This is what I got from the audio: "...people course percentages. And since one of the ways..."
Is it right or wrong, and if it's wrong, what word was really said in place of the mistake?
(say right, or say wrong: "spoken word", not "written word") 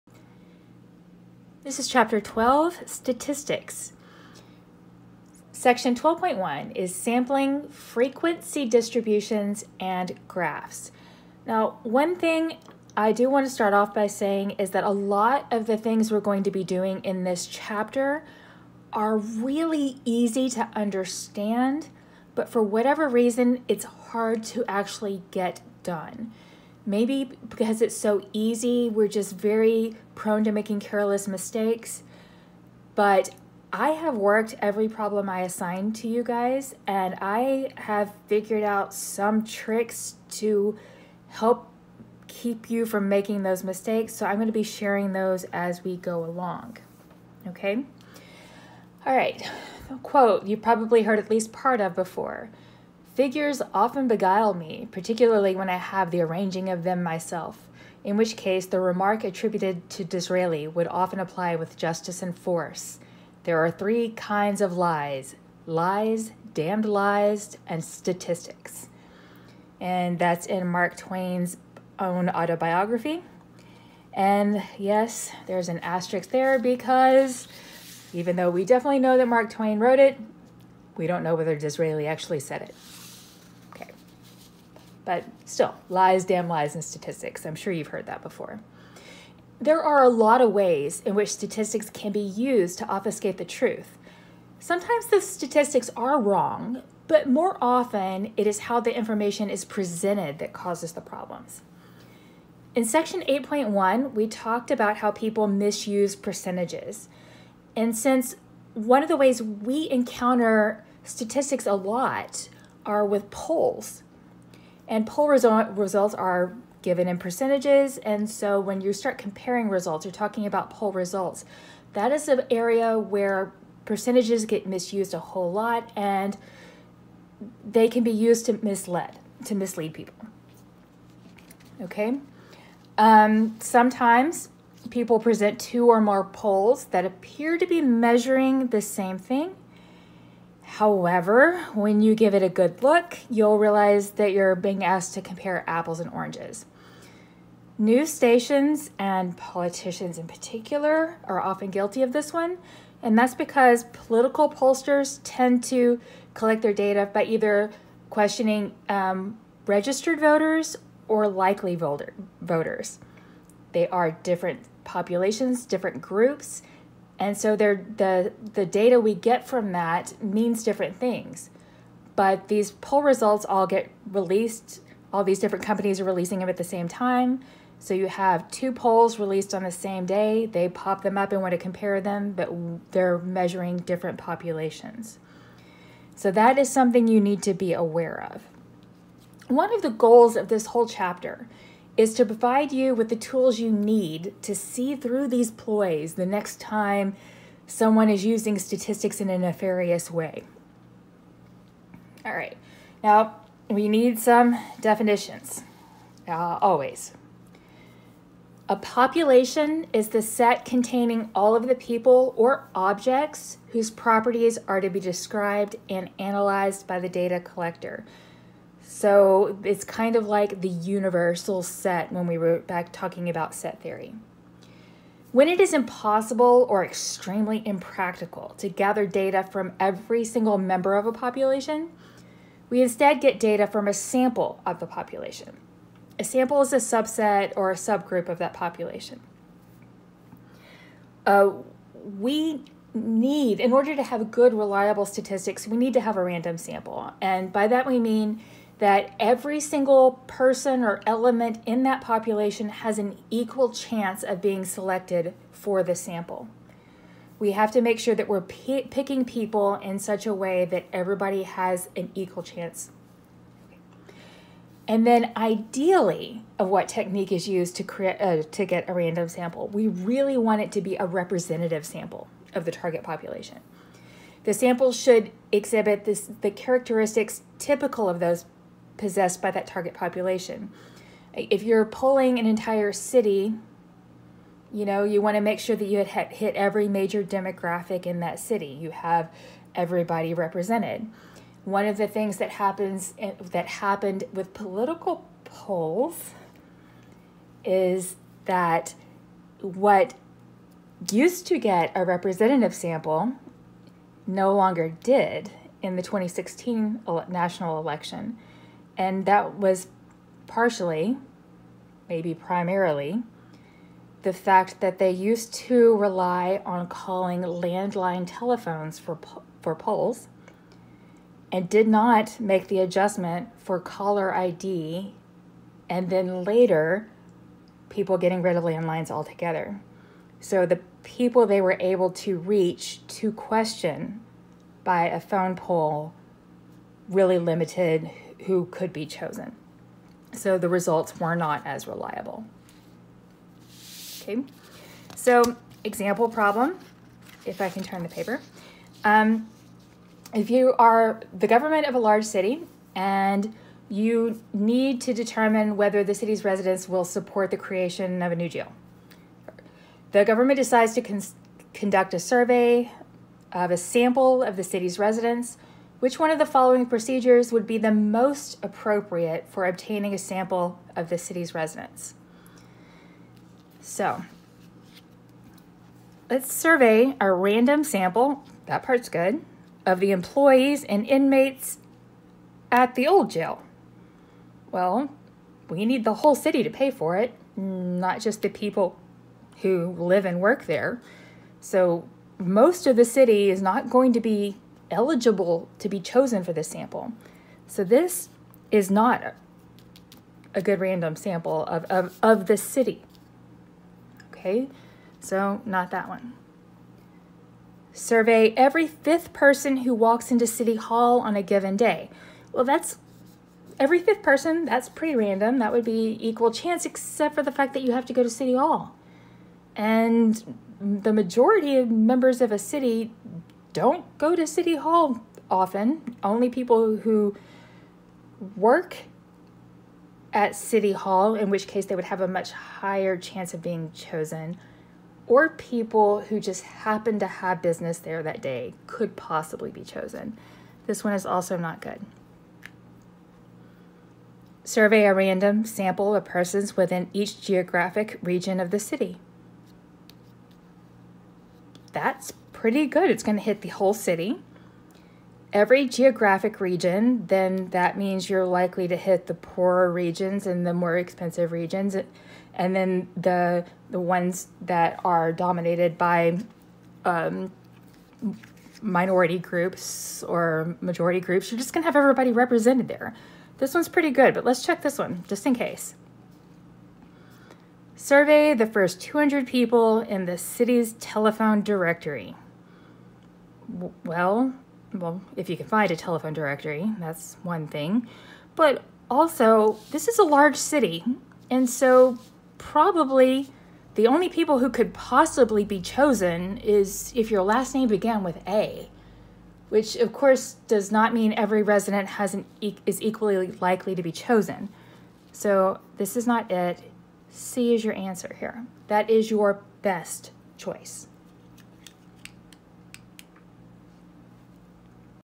wrong: "misuse", not "course".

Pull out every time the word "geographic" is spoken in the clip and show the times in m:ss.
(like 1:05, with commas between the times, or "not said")
7:27, 7:35.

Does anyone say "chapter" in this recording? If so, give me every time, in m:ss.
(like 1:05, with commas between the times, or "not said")
0:01, 0:17, 3:10.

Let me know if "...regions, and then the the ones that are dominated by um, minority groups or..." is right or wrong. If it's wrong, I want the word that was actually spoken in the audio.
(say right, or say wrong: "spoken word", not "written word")
right.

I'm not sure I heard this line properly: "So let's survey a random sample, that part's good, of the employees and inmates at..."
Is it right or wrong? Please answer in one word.
right.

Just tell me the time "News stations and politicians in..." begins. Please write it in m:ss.
2:27.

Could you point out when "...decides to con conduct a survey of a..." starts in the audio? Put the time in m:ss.
6:00.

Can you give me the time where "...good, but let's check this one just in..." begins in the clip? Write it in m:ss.
7:54.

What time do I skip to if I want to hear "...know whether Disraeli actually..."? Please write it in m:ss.
1:21.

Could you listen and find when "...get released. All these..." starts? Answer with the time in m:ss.
2:53.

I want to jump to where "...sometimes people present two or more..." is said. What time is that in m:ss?
2:13.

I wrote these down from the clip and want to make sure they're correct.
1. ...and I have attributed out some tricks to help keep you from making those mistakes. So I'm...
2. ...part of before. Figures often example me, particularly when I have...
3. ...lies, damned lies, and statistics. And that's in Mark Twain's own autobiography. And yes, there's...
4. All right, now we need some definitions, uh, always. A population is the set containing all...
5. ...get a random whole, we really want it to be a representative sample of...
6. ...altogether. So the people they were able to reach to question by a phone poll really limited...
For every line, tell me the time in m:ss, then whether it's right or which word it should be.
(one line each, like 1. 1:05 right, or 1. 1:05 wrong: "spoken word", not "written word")
1. 0:36 wrong: "figured", not "attributed"
2. 0:51 wrong: "beguile", not "example"
3. 1:05 right
4. 3:22 right
5. 4:28 wrong: "sample", not "whole"
6. 5:29 right.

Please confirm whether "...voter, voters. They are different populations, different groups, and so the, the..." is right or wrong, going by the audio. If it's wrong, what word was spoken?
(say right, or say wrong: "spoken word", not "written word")
right.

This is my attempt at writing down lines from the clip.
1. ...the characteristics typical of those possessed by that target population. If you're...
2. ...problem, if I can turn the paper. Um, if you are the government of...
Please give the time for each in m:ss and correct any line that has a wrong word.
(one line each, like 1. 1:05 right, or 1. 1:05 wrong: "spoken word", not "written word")
1. 4:36 right
2. 5:46 right.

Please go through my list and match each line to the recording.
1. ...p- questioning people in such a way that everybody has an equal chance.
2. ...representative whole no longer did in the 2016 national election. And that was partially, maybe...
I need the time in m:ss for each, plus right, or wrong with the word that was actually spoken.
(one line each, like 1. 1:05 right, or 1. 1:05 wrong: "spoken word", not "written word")
1. 4:18 wrong: "picking", not "questioning"
2. 5:02 wrong: "sample", not "whole".